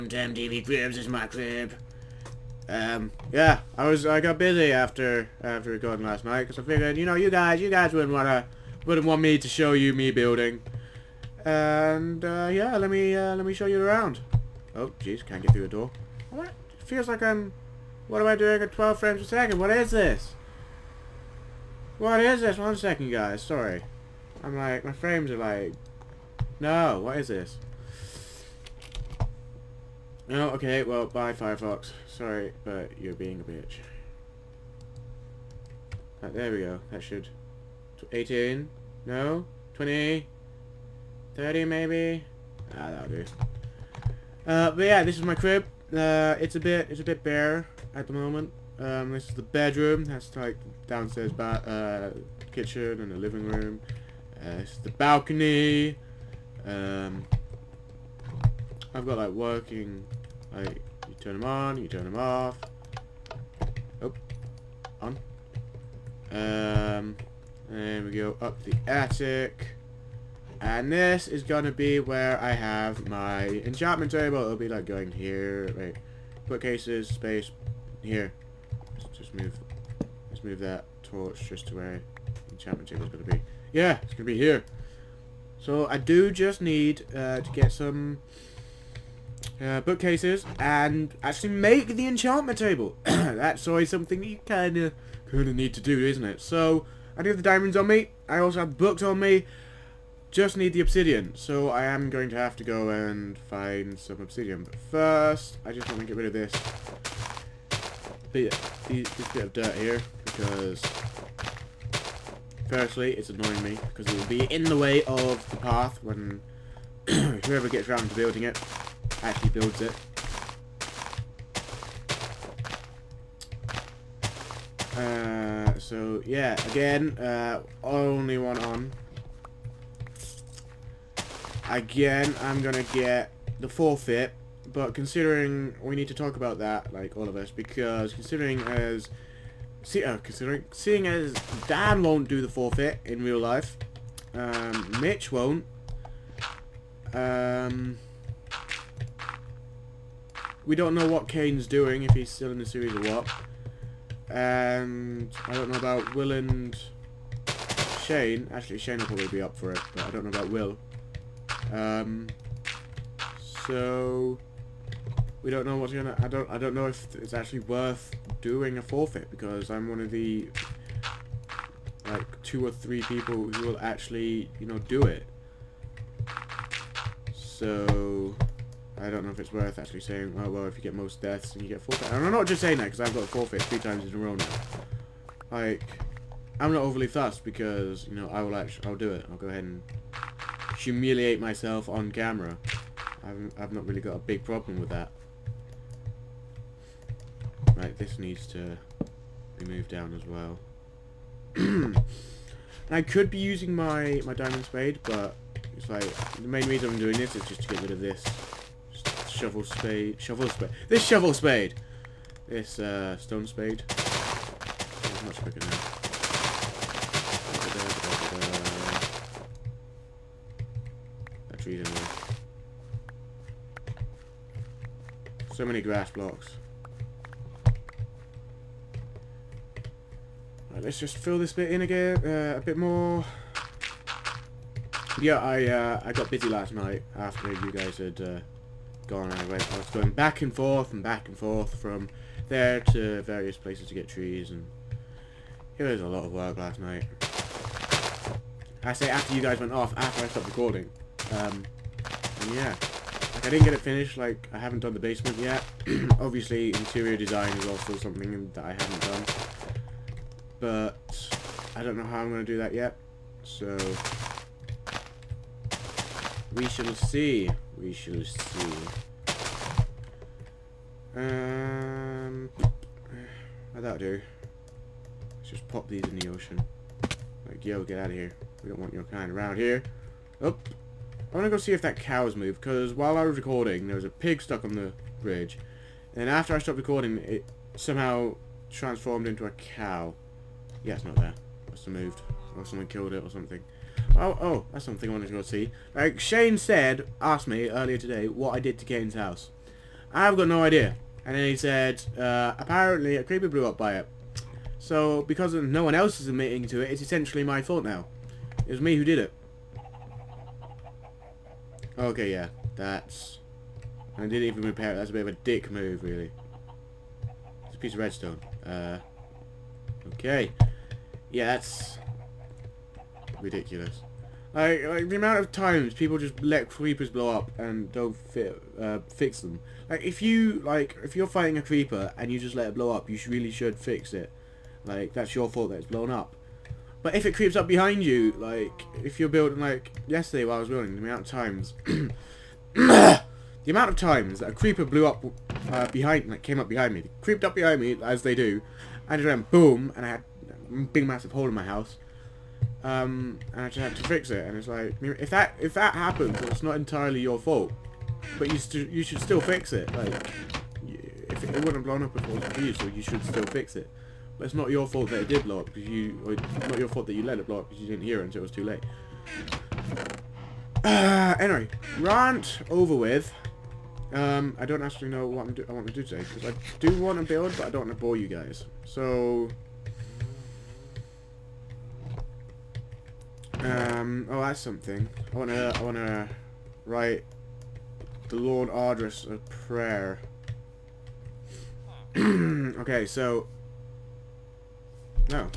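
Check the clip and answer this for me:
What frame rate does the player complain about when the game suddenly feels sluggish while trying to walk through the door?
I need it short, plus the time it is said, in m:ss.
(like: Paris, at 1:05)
12 frames a second, at 0:18.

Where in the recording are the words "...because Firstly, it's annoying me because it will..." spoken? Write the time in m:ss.
1:50.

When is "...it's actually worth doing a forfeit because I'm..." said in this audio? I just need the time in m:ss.
2:47.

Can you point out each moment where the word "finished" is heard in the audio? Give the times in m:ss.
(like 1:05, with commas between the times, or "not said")
4:13.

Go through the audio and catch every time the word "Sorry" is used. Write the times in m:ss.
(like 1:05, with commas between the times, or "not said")
0:23, 0:32.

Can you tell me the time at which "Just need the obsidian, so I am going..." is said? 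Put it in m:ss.
1:40.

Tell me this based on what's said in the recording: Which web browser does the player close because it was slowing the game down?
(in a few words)
Firefox.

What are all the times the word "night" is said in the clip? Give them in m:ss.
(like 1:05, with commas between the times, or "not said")
0:06, 3:56, 4:06.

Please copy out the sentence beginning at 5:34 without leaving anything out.
Like, that's your fault that it's blown up.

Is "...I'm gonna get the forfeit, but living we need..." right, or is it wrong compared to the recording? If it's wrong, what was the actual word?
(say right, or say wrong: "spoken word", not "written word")
wrong: "considering", not "living".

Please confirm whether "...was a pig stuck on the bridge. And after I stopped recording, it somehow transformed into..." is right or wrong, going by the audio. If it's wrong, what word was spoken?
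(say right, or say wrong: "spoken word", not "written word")
right.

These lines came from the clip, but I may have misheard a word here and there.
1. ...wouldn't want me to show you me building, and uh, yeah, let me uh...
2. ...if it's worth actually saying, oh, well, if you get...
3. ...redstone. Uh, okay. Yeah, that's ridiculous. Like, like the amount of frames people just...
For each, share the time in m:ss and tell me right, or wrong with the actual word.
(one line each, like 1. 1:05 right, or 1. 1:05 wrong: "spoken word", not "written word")
1. 0:08 right
2. 2:59 right
3. 5:17 wrong: "times", not "frames".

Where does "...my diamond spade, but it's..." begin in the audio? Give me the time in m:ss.
3:24.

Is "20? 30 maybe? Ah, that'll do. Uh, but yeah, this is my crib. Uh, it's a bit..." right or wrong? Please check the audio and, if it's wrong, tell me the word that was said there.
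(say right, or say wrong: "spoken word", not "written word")
right.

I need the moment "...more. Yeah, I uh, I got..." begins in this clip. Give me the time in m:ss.
3:52.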